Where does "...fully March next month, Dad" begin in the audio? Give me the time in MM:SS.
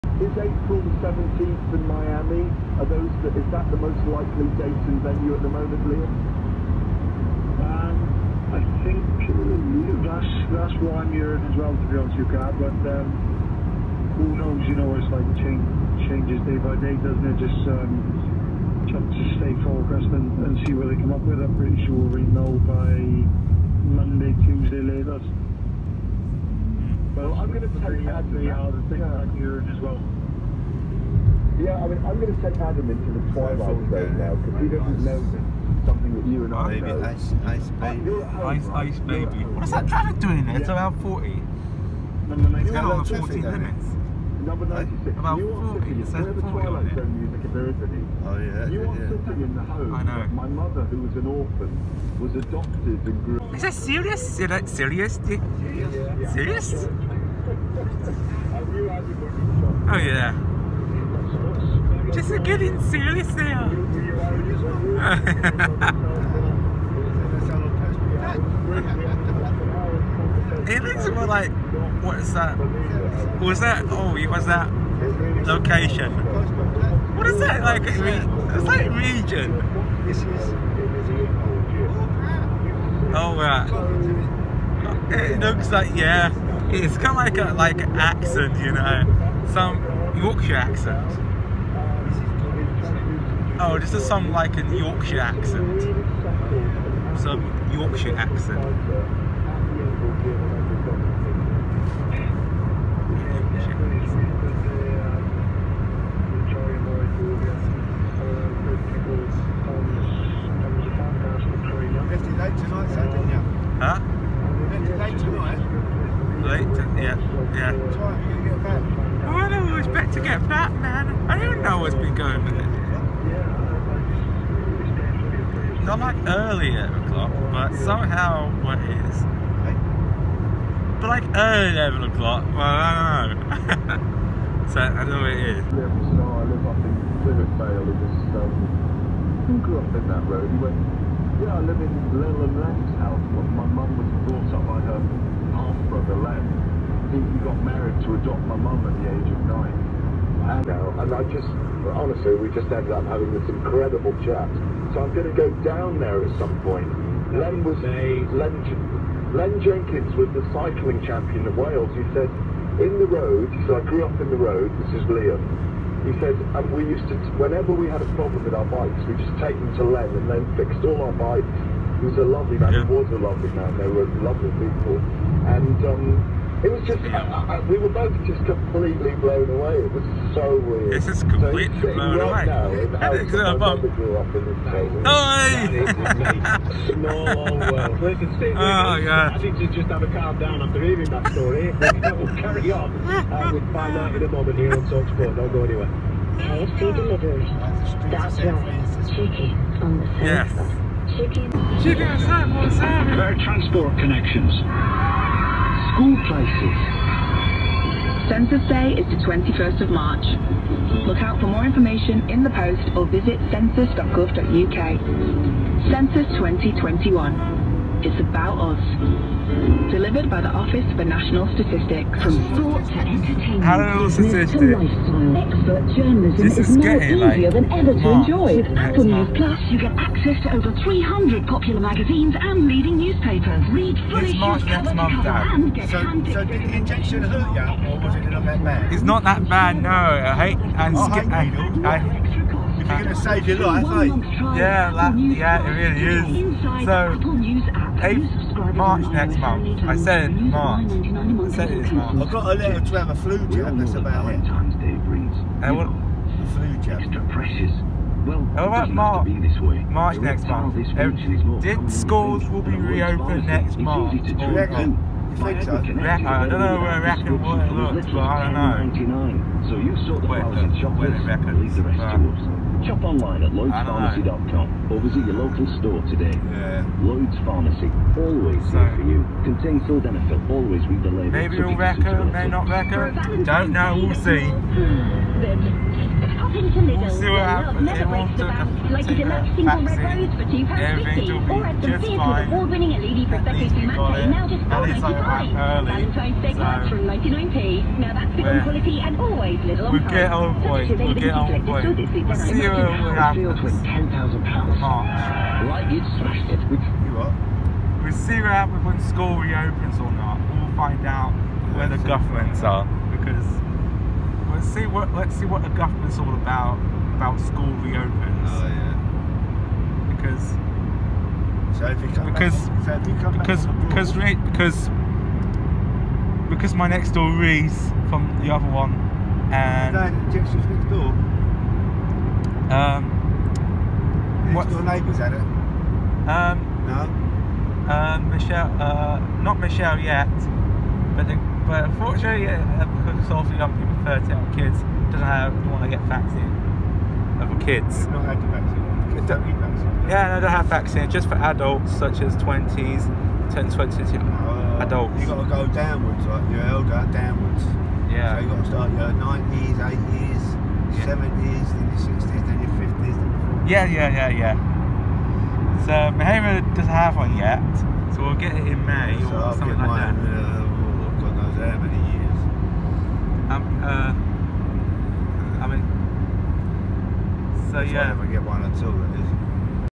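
03:54.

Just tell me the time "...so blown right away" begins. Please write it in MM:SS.
03:01.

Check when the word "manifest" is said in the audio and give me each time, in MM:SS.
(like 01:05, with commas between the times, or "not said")
not said.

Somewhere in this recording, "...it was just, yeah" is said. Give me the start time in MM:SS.
02:56.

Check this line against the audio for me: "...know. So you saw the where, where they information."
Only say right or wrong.
wrong.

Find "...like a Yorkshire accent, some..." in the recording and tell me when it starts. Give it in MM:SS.
01:34.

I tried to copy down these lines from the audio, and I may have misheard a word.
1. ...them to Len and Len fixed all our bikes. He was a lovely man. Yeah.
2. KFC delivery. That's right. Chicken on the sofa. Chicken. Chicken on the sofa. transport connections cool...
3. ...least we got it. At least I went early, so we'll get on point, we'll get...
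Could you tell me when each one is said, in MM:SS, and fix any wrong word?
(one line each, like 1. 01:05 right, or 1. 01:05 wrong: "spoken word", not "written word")
1. 02:49 right
2. 03:16 right
3. 04:52 right.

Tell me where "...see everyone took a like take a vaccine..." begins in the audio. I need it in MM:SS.
04:44.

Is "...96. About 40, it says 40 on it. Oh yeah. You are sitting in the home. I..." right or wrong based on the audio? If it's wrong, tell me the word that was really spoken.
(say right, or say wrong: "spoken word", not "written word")
right.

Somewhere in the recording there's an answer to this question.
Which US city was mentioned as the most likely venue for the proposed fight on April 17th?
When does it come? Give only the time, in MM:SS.
00:01.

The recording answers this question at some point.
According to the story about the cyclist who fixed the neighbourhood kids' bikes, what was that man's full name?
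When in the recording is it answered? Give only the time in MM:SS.
02:39.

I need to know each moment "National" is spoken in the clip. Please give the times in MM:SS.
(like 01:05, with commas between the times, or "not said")
03:41.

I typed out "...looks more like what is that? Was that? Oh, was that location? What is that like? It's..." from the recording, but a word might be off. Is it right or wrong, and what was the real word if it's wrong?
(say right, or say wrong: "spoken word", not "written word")
right.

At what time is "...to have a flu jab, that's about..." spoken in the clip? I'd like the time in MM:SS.
04:12.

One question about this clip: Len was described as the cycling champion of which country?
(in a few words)
Wales.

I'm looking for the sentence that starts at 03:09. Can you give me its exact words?
I need to just have a calm down after hearing that story.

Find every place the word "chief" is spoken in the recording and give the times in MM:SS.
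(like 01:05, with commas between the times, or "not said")
not said.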